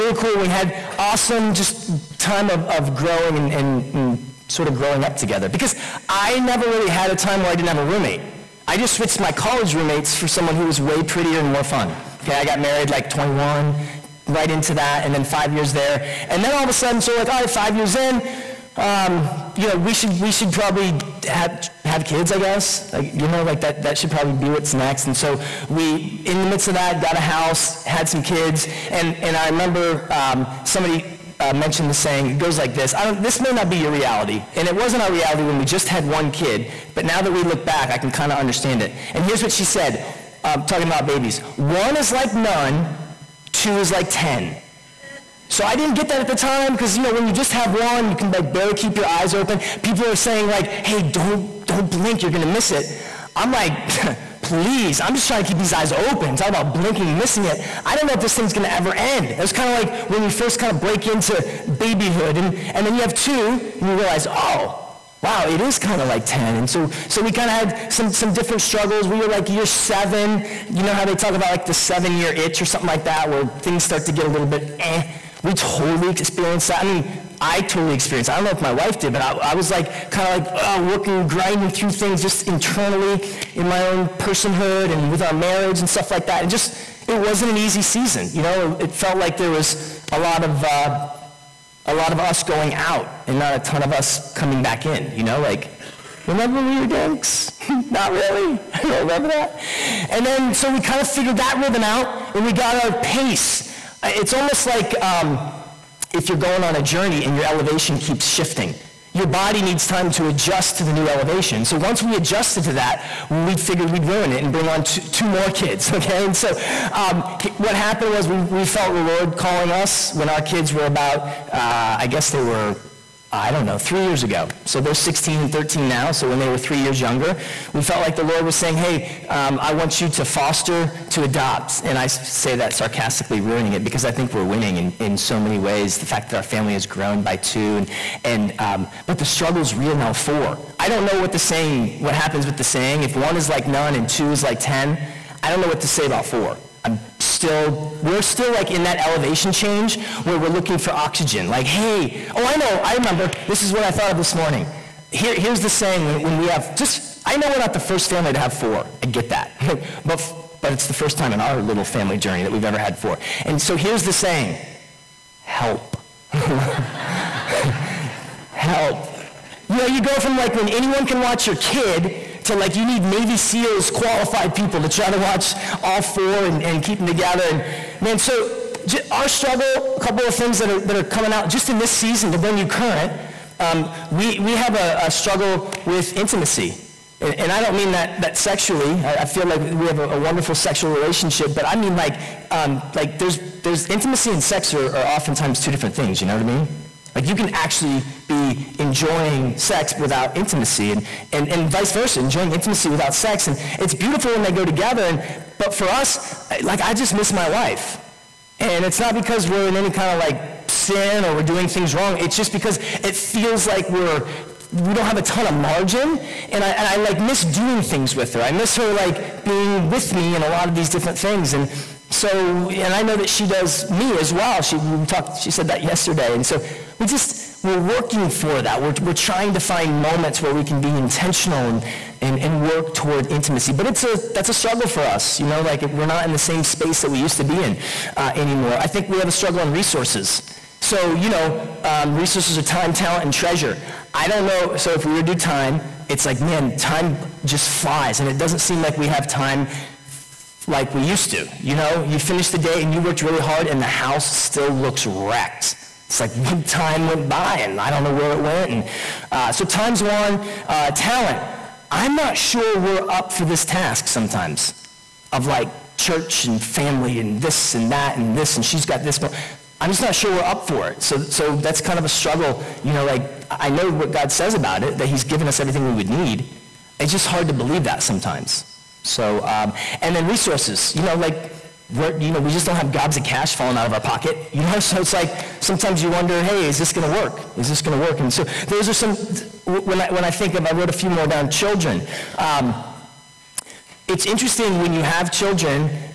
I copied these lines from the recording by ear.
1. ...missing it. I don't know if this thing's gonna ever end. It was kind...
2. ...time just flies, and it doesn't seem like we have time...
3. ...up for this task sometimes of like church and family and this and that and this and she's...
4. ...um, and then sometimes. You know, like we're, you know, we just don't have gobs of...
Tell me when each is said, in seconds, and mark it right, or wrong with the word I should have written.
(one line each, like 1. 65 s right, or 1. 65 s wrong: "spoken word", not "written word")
1. 57 s right
2. 246 s right
3. 263 s right
4. 279 s wrong: "resources", not "sometimes".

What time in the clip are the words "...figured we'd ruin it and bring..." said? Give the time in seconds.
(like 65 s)
113 s.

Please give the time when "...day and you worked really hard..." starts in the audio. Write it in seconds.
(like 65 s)
252 s.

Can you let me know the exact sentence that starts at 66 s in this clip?
And so, so we kind of had some, some different struggles.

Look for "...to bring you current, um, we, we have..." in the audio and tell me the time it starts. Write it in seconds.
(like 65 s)
182 s.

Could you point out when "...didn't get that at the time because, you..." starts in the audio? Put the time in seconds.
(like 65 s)
45 s.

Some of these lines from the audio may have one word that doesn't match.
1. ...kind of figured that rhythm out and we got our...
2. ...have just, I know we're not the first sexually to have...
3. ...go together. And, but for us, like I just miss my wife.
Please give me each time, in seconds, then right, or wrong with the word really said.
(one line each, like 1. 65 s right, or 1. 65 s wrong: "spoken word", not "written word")
1. 100 s right
2. 156 s wrong: "family", not "sexually"
3. 204 s right.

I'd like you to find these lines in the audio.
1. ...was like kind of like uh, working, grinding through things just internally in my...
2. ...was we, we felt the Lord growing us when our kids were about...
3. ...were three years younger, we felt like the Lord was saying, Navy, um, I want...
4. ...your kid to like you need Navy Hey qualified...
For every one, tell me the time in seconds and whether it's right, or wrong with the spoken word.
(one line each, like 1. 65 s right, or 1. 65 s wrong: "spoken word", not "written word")
1. 79 s right
2. 118 s wrong: "calling", not "growing"
3. 126 s wrong: "Hey", not "Navy"
4. 171 s wrong: "SEALs", not "Hey".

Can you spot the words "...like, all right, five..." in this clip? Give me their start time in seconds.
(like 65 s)
17 s.